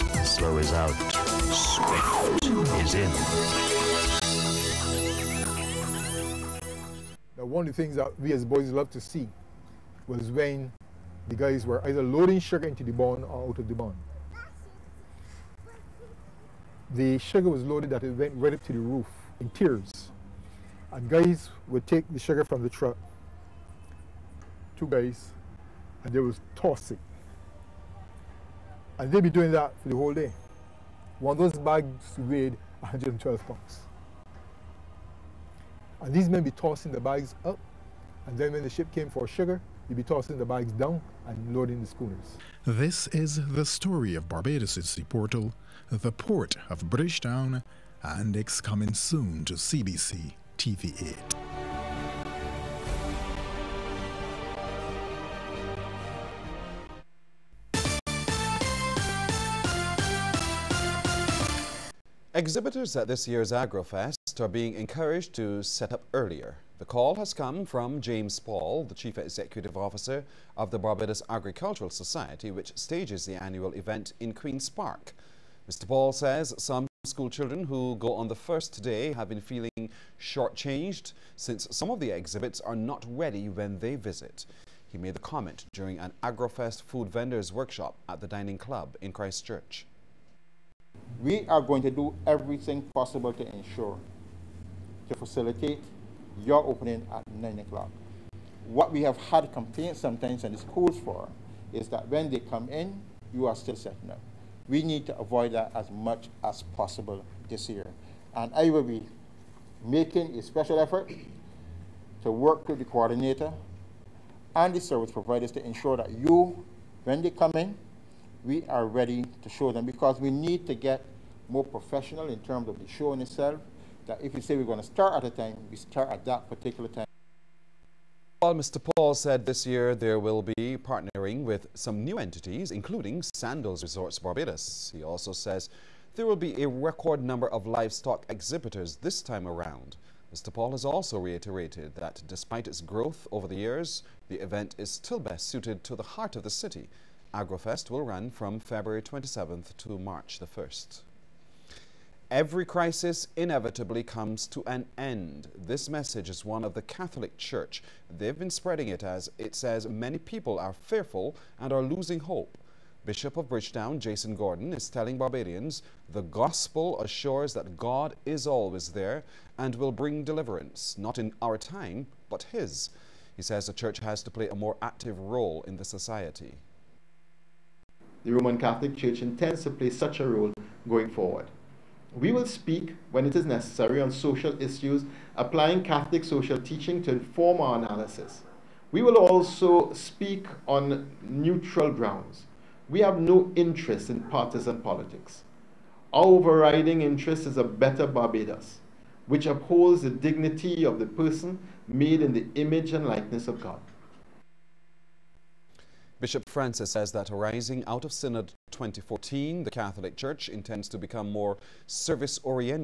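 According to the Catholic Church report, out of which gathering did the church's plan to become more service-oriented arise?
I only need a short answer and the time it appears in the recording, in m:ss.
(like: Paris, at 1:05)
Synod 2014, at 3:28.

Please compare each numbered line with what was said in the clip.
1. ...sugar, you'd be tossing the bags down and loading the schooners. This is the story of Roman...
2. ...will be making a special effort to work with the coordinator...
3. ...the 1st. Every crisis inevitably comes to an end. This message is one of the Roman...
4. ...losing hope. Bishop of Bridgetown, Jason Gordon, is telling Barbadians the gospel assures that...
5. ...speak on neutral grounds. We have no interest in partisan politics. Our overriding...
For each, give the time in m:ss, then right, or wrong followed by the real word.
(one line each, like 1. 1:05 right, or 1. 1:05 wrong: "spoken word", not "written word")
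1. 0:39 wrong: "Barbados", not "Roman"
2. 1:48 right
3. 2:30 wrong: "Catholic", not "Roman"
4. 2:41 right
5. 3:09 right.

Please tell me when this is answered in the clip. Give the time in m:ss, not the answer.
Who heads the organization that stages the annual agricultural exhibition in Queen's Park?
1:08.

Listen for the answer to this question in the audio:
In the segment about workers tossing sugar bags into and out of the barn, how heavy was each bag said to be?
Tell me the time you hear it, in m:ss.
0:32.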